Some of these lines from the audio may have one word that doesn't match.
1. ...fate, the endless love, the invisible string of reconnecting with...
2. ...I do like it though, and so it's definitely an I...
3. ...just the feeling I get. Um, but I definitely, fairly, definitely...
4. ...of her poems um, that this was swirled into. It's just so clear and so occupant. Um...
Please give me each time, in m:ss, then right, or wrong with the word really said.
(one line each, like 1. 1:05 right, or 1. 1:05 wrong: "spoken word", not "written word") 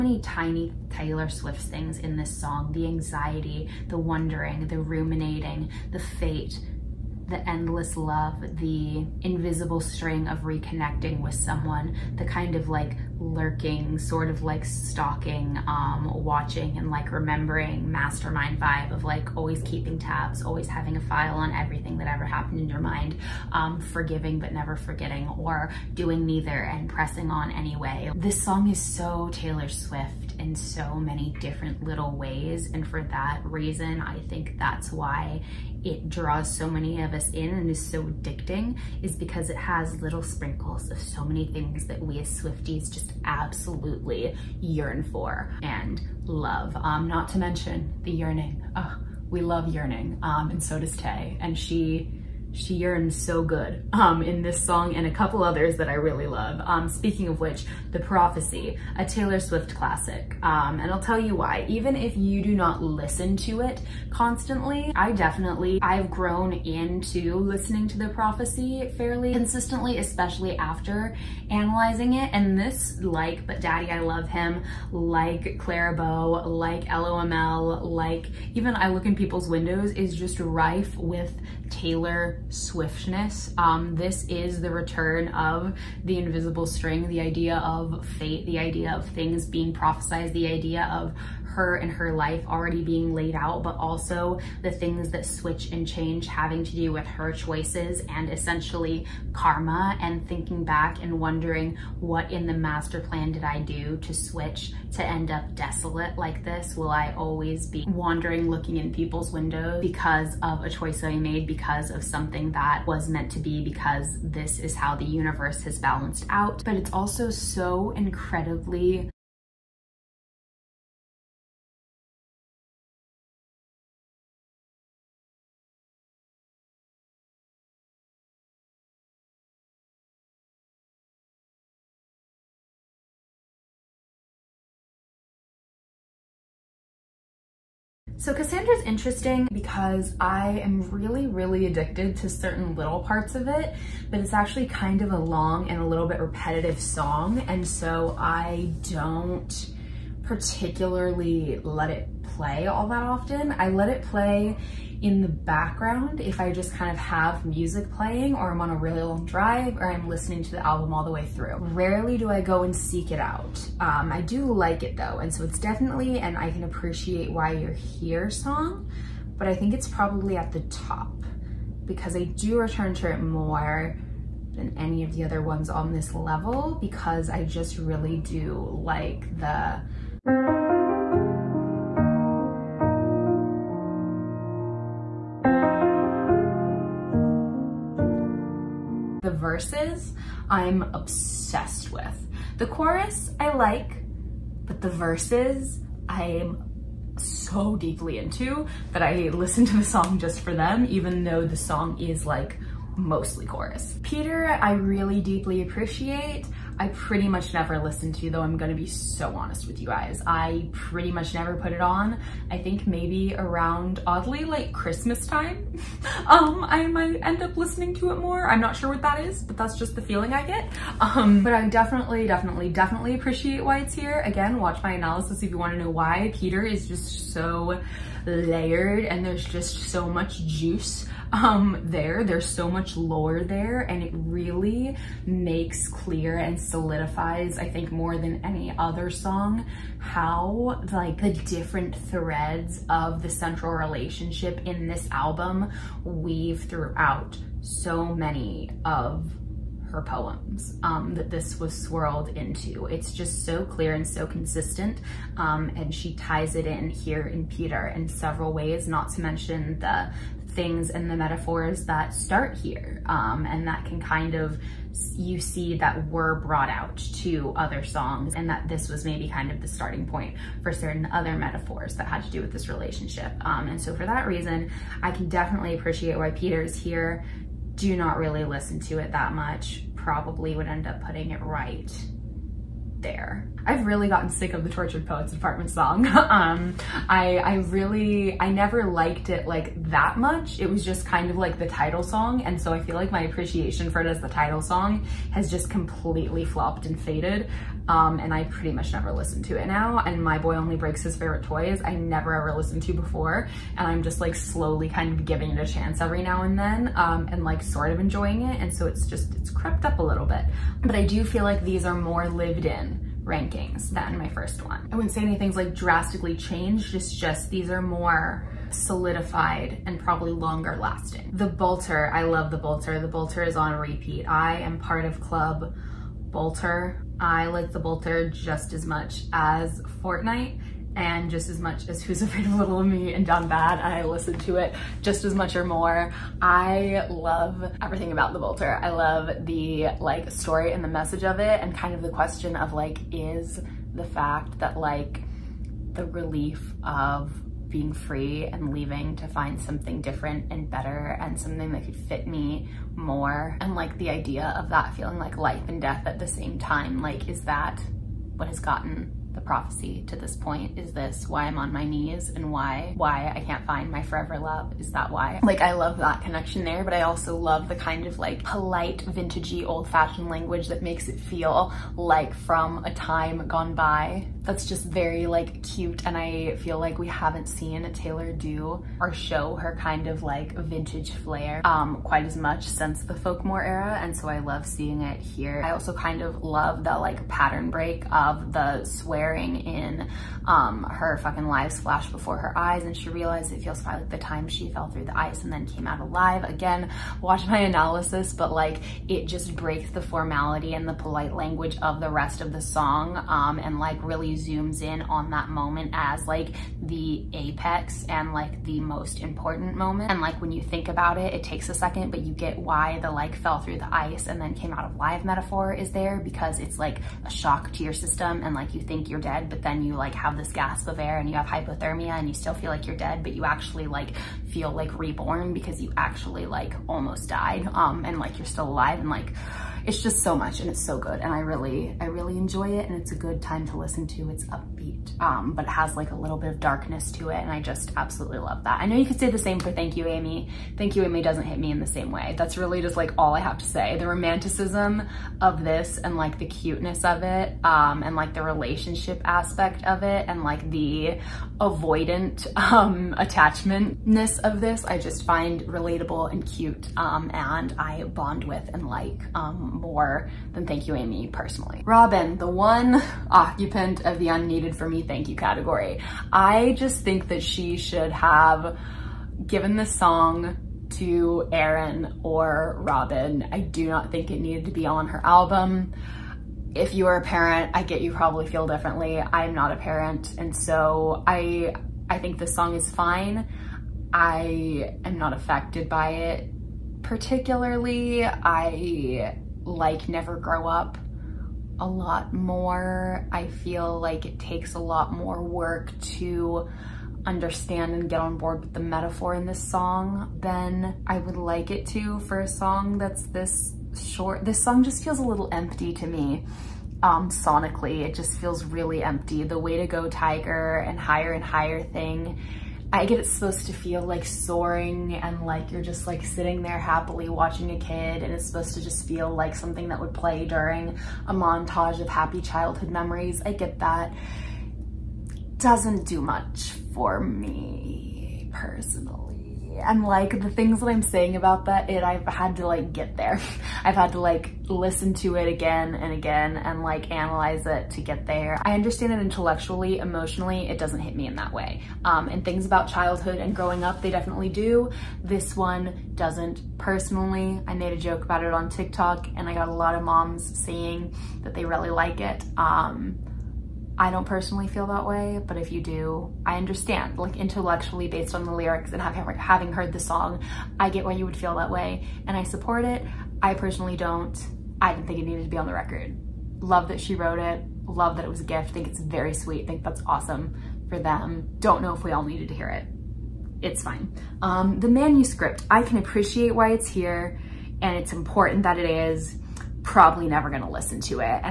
1. 0:05 right
2. 2:44 right
3. 3:39 wrong: "definitely", not "fairly"
4. 4:08 wrong: "consistent", not "occupant".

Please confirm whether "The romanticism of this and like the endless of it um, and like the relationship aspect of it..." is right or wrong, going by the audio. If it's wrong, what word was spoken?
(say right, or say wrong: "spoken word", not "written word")
wrong: "cuteness", not "endless".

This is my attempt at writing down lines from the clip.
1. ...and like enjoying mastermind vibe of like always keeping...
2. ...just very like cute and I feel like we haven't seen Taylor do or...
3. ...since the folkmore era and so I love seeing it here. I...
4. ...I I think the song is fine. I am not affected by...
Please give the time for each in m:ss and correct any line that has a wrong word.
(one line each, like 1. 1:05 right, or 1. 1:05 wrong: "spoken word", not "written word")
1. 0:16 wrong: "remembering", not "enjoying"
2. 6:14 right
3. 6:22 right
4. 8:01 right.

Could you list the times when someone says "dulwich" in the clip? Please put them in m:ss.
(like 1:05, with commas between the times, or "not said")
not said.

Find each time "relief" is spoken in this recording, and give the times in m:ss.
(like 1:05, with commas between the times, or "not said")
5:46.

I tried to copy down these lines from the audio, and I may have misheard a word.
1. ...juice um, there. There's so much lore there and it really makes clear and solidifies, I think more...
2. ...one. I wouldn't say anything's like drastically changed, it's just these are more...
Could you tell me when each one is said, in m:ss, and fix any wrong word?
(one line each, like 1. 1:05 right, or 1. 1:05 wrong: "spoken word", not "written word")
1. 3:50 right
2. 5:14 right.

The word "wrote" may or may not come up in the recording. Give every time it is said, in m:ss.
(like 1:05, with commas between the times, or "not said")
9:27.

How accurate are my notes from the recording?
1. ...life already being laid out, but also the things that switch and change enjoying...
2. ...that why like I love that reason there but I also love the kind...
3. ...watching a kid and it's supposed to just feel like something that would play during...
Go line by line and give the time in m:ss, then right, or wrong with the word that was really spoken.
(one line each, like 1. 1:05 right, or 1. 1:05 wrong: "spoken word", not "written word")
1. 1:32 wrong: "having", not "enjoying"
2. 6:04 wrong: "connection", not "reason"
3. 8:37 right.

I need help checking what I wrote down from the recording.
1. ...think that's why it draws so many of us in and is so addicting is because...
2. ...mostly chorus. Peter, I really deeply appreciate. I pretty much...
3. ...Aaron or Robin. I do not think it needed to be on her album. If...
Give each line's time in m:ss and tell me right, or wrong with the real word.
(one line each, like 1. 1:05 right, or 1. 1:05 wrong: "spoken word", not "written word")
1. 0:34 right
2. 3:22 right
3. 7:51 right.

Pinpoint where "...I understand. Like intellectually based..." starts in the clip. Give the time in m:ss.
9:16.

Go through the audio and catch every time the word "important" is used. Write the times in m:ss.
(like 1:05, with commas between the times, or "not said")
6:49, 9:38.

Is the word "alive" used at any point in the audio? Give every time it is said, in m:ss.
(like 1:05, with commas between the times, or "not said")
6:35, 7:08.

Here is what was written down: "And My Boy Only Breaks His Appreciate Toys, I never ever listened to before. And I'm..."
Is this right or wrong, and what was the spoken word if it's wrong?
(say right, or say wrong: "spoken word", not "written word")
wrong: "Favorite", not "Appreciate".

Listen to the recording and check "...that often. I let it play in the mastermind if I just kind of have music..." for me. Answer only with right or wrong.
wrong.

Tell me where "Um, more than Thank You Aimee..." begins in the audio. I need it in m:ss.
7:39.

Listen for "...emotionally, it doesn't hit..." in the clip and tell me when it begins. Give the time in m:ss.
8:59.